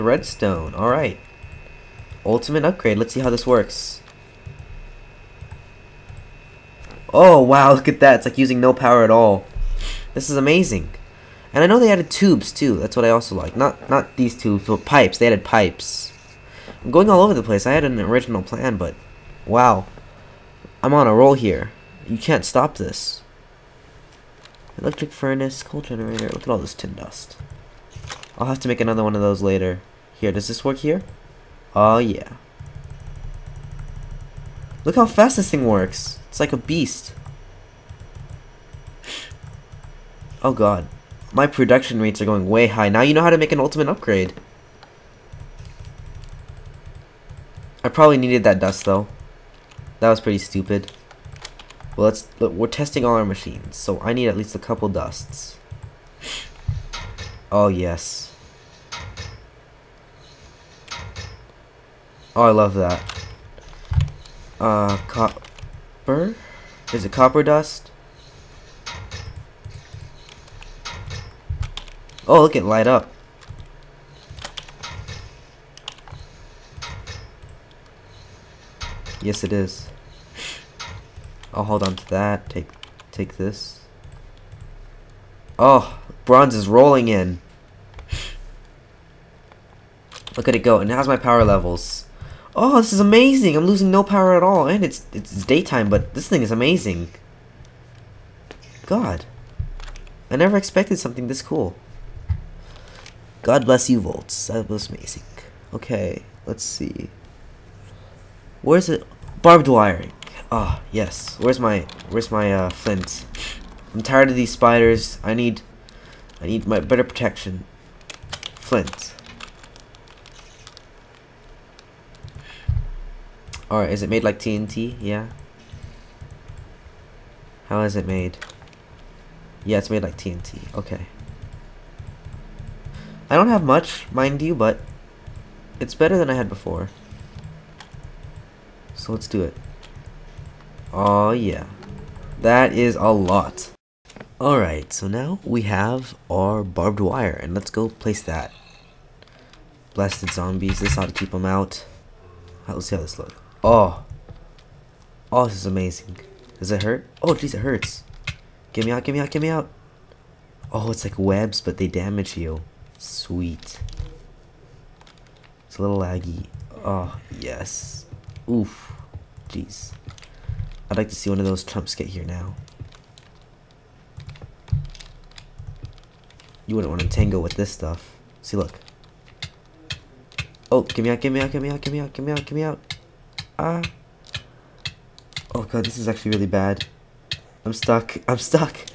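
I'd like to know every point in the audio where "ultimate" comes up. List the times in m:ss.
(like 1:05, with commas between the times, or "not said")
0:02, 0:43.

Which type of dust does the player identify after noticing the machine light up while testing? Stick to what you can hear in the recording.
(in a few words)
Copper dust.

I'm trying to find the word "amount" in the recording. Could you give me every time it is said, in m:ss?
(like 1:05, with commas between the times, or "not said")
not said.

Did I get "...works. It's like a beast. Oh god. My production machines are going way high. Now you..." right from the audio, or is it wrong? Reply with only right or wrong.
wrong.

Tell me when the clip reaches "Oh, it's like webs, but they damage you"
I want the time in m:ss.
2:40.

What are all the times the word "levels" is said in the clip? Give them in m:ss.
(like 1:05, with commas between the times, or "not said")
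1:31.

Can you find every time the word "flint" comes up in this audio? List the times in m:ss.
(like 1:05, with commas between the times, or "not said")
1:52, 1:58.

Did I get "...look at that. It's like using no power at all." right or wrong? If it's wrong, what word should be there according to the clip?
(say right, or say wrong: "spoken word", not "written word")
right.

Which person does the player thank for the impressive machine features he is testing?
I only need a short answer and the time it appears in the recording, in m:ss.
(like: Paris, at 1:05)
Voltz, at 1:44.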